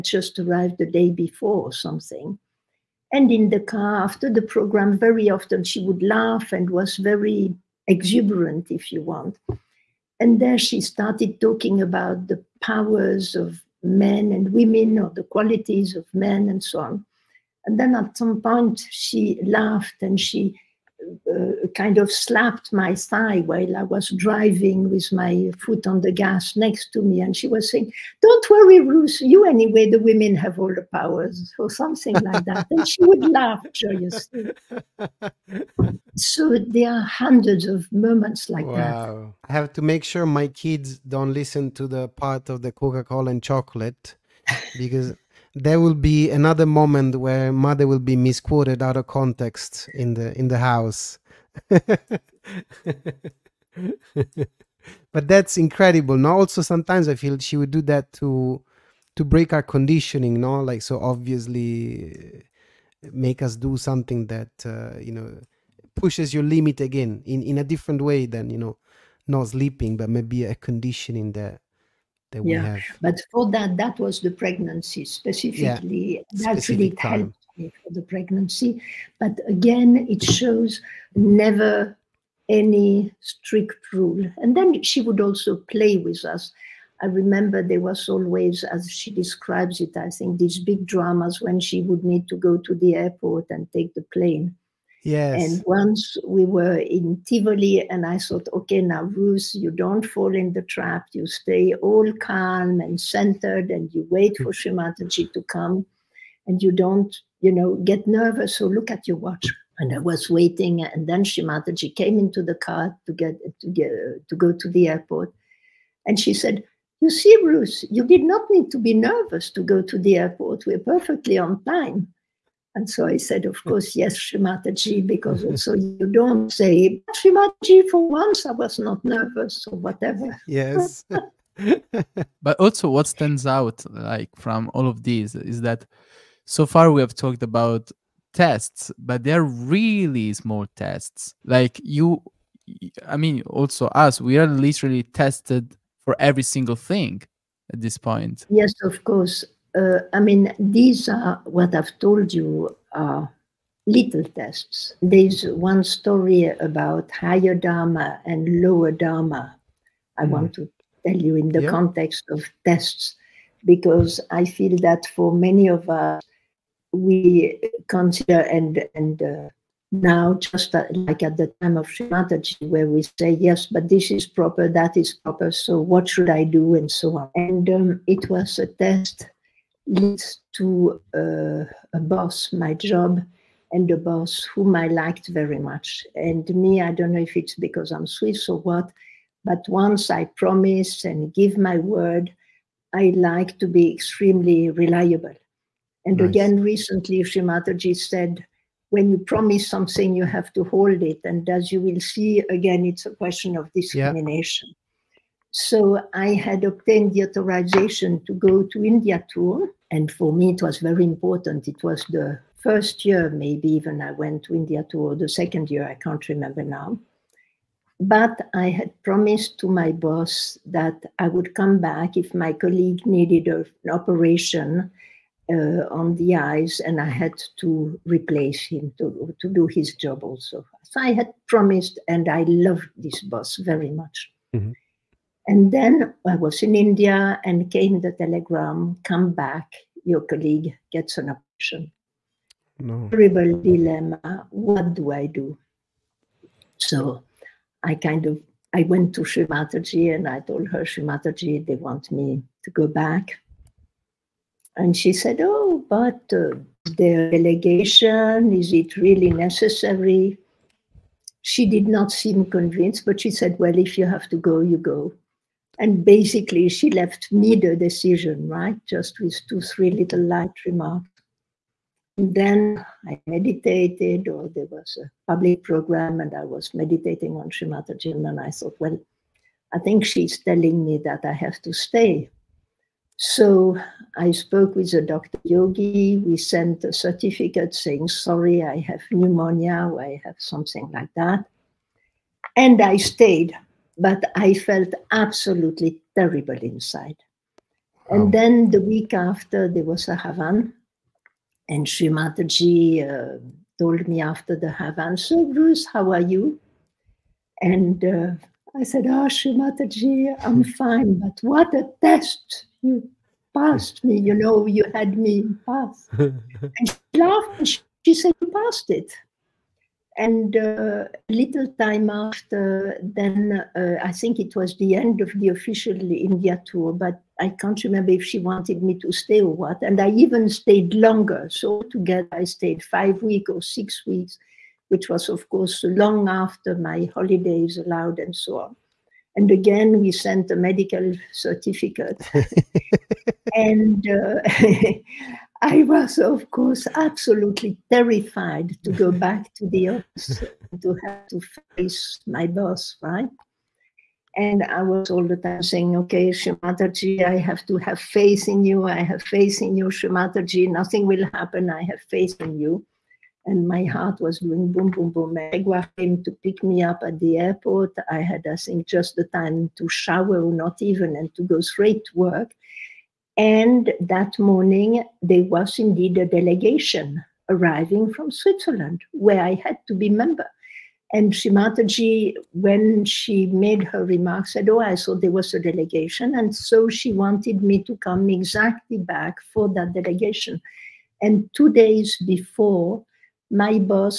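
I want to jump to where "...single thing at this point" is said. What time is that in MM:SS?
02:26.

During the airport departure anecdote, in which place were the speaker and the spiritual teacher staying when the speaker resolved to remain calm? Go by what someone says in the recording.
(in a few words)
Tivoli.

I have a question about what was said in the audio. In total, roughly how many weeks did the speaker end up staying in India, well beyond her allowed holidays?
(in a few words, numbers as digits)
5 or 6 weeks.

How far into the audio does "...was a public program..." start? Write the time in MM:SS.
04:34.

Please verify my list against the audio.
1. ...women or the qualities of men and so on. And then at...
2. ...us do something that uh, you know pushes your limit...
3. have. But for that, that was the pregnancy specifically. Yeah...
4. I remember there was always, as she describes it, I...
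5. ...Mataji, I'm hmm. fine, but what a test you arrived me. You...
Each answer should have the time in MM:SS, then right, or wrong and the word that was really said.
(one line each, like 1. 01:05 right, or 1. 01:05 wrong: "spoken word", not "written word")
1. 00:14 right
2. 01:03 right
3. 01:12 right
4. 01:27 right
5. 05:09 wrong: "passed", not "arrived".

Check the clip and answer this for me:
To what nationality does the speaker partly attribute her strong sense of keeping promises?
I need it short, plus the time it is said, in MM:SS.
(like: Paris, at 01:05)
Swiss, at 03:08.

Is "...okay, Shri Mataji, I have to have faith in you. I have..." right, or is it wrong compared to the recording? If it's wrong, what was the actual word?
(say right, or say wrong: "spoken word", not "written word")
right.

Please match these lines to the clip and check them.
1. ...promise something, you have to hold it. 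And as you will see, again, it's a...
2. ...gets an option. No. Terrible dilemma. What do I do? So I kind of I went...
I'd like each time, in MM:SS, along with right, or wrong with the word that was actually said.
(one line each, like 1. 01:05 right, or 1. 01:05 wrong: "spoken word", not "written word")
1. 03:19 right
2. 04:00 right.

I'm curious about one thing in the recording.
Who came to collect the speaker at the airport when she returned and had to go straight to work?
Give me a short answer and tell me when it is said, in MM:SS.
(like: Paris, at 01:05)
Megwa, at 06:05.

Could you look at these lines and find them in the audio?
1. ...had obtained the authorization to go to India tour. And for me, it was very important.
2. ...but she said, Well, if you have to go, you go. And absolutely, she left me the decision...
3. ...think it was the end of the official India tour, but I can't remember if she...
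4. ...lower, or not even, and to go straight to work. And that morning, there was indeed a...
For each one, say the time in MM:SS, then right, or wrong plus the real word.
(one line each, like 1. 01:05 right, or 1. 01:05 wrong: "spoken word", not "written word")
1. 03:26 right
2. 04:23 wrong: "basically", not "absolutely"
3. 05:24 right
4. 06:09 wrong: "shower", not "lower".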